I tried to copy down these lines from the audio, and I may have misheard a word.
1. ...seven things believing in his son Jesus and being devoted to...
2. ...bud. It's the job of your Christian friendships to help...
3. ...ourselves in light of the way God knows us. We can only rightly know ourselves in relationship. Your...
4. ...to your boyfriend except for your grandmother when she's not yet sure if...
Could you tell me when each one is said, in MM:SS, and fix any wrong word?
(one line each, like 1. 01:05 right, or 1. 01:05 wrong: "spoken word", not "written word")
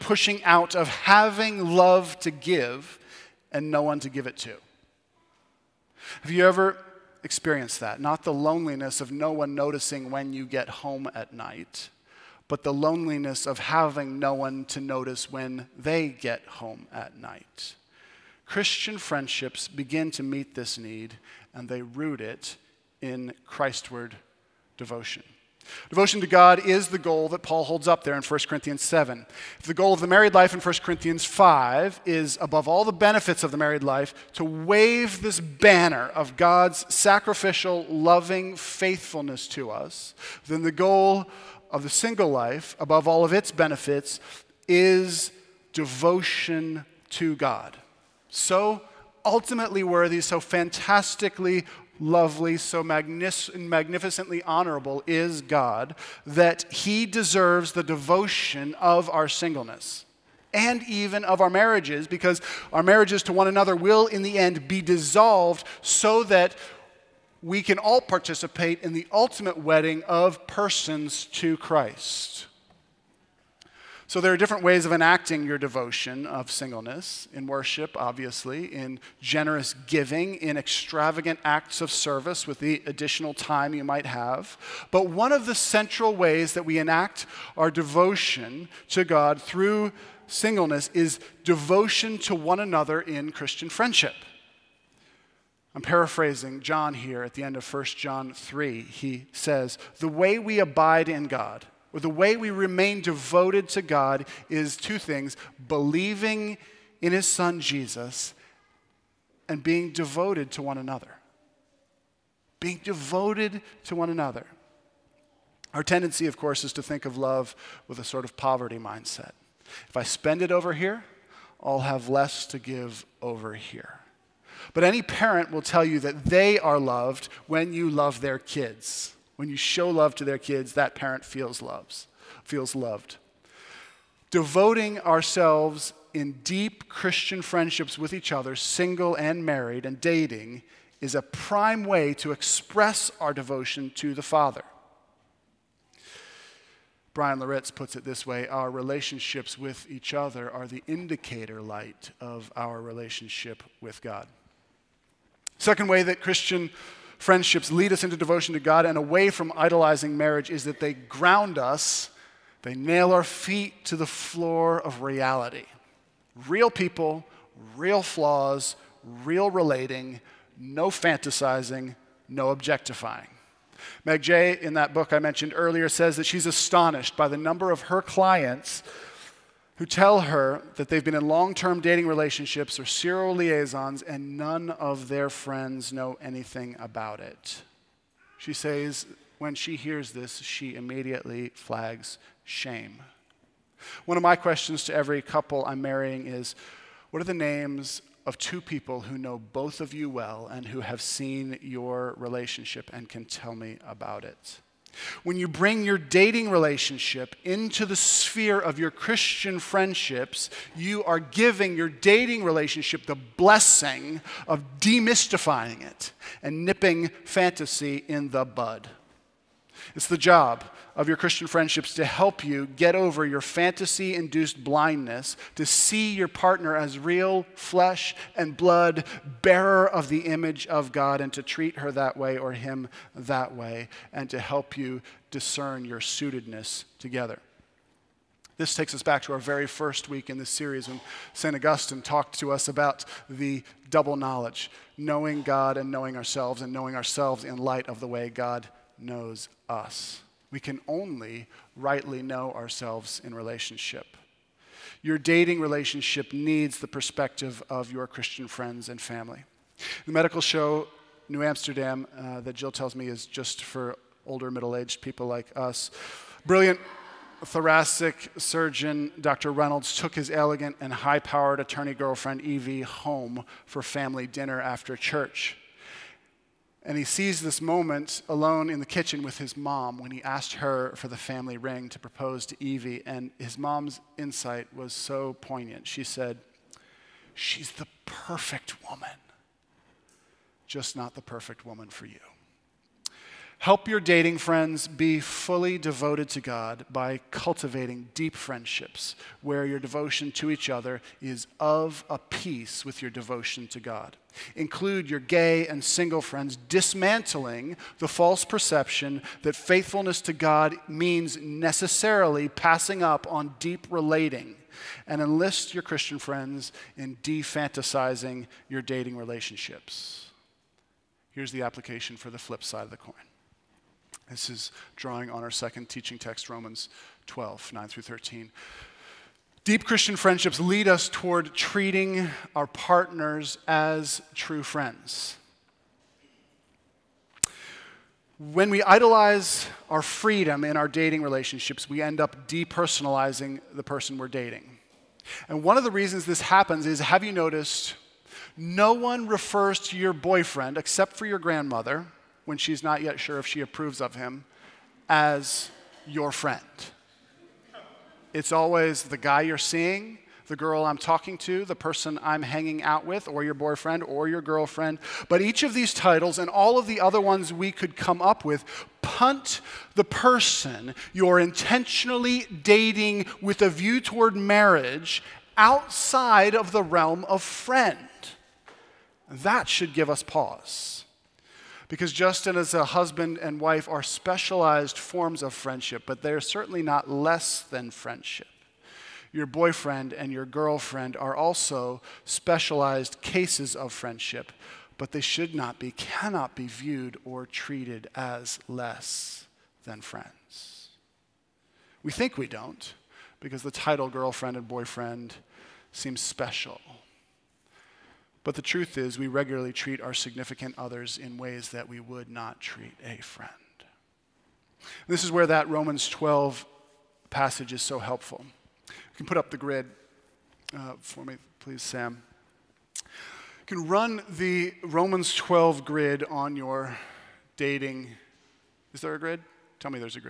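1. 01:44 wrong: "two", not "seven"
2. 03:38 right
3. 04:06 right
4. 05:49 right.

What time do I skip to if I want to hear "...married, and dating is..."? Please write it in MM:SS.
02:19.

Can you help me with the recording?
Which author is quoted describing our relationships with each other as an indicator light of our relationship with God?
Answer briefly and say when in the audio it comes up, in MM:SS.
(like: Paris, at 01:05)
Bryan Loritts, at 02:27.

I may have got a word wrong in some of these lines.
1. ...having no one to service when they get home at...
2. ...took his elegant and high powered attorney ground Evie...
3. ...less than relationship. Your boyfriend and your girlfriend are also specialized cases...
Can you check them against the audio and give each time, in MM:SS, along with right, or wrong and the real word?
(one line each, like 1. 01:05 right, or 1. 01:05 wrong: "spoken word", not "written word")
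1. 00:13 wrong: "notice", not "service"
2. 04:29 wrong: "girlfriend", not "ground"
3. 06:27 wrong: "friendship", not "relationship".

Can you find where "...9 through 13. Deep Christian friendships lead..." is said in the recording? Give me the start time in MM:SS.
05:27.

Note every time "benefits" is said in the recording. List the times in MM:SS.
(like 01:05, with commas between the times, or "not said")
00:32, 00:43.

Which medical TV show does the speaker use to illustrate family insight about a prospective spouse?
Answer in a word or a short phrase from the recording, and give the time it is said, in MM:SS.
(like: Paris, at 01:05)
New Amsterdam, at 04:21.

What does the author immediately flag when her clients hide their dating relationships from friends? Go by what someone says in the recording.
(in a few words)
Shame.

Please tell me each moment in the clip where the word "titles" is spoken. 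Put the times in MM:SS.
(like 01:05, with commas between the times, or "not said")
06:05, 06:43.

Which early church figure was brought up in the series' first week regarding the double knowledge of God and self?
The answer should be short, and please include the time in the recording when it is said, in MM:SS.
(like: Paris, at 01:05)
St. Augustine, at 04:01.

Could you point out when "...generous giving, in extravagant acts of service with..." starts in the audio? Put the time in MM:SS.
01:19.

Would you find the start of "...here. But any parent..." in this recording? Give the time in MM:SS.
02:03.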